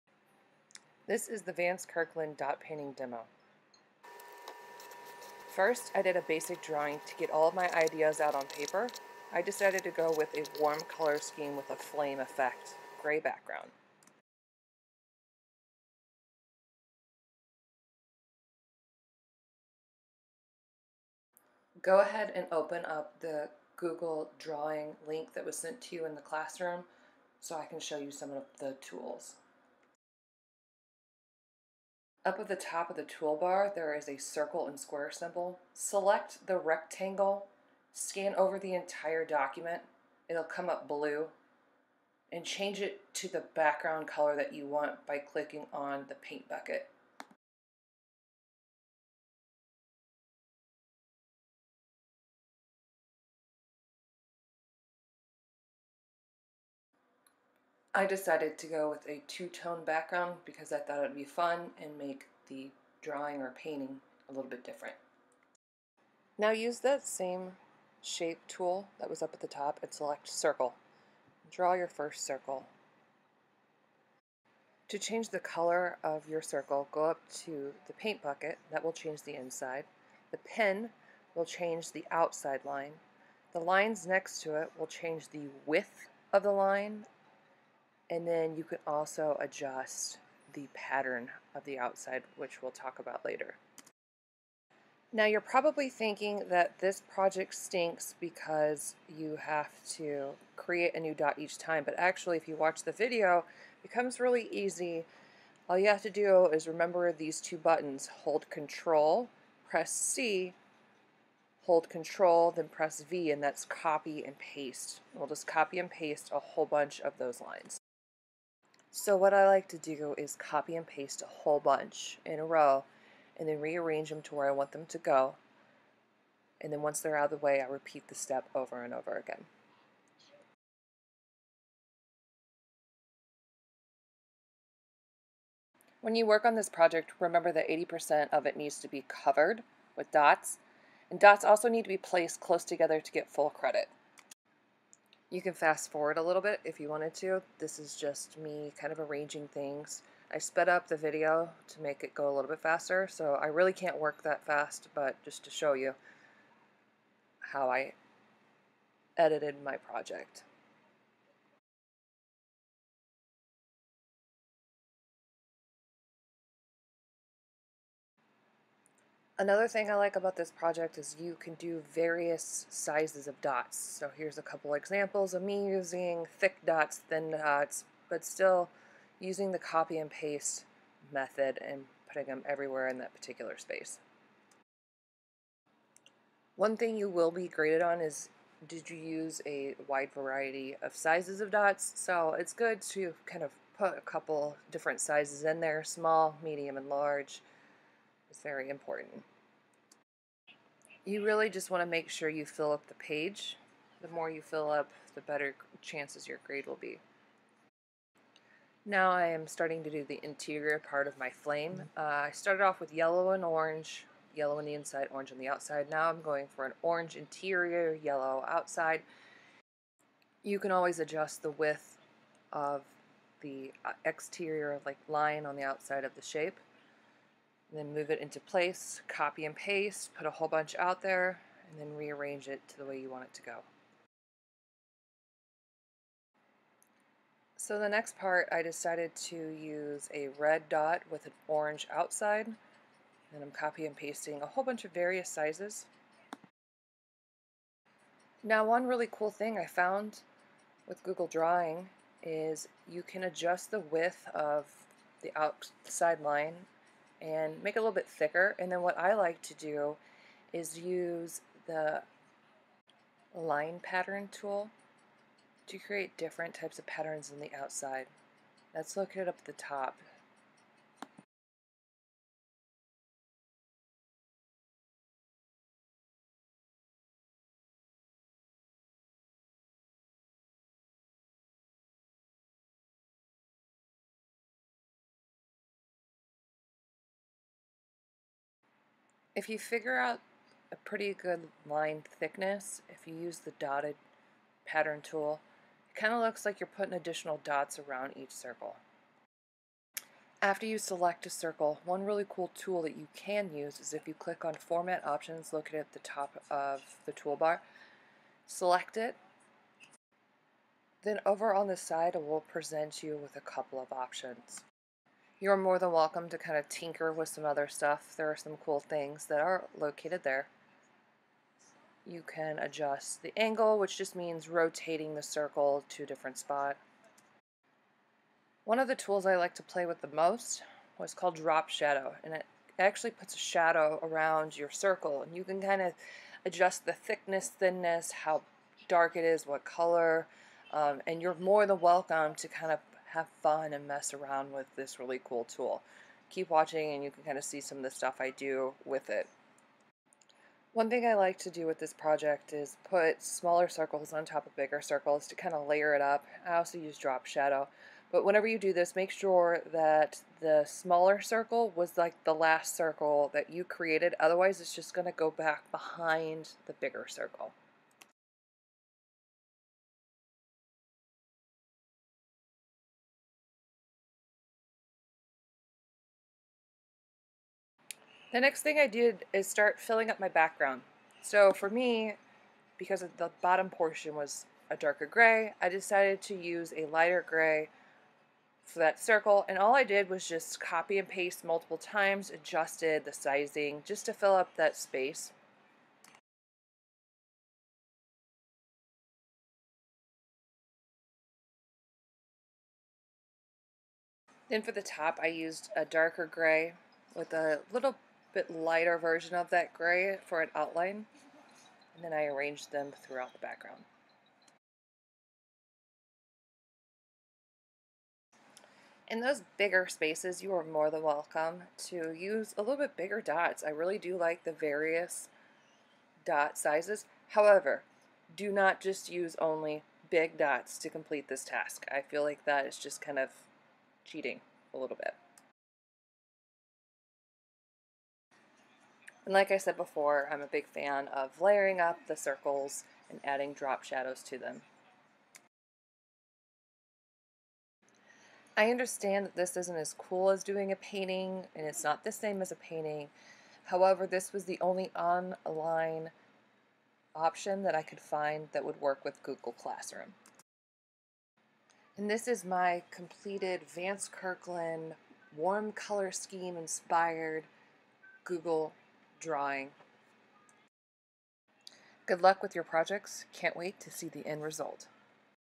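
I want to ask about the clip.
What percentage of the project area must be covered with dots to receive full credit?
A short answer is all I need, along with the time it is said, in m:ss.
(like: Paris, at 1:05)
80%, at 2:17.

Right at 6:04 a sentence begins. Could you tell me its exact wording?
Otherwise, it's just going to go back behind the bigger circle.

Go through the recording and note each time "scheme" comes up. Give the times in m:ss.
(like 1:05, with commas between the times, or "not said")
0:11, 7:46.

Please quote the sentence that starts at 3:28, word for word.
Now I am starting to do the interior part of my flame.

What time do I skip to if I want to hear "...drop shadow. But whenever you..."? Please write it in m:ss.
5:56.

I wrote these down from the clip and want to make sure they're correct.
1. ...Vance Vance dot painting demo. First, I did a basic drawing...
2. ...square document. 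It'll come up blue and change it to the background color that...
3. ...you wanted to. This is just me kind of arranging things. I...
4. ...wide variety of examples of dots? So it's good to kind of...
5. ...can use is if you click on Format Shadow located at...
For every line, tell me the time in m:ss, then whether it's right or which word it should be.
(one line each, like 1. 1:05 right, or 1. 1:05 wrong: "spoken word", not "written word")
1. 0:01 wrong: "Kirkland", not "Vance"
2. 0:38 wrong: "entire", not "square"
3. 2:26 right
4. 3:09 wrong: "sizes", not "examples"
5. 5:03 wrong: "Options", not "Shadow".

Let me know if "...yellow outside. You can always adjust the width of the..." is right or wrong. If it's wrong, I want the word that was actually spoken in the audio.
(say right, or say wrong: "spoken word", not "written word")
right.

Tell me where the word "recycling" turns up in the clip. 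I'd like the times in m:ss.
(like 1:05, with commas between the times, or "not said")
not said.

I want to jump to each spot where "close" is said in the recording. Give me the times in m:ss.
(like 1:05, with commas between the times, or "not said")
2:22.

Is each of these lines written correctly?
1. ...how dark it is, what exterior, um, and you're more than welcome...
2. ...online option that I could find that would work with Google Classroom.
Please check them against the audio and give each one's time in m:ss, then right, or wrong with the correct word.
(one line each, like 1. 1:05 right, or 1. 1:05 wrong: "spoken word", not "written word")
1. 5:38 wrong: "color", not "exterior"
2. 7:34 right.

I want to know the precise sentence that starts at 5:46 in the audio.
Keep watching and you can kind of see some of the stuff I do with it.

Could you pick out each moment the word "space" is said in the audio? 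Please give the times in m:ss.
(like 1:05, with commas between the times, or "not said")
3:03, 6:34, 6:59.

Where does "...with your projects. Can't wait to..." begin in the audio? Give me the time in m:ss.
7:52.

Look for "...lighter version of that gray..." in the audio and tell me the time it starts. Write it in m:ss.
6:48.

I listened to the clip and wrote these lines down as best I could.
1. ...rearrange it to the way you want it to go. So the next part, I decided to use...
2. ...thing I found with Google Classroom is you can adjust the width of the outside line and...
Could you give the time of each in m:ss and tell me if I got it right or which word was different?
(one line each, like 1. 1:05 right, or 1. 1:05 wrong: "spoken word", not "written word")
1. 3:51 right
2. 4:09 wrong: "Drawing", not "Classroom".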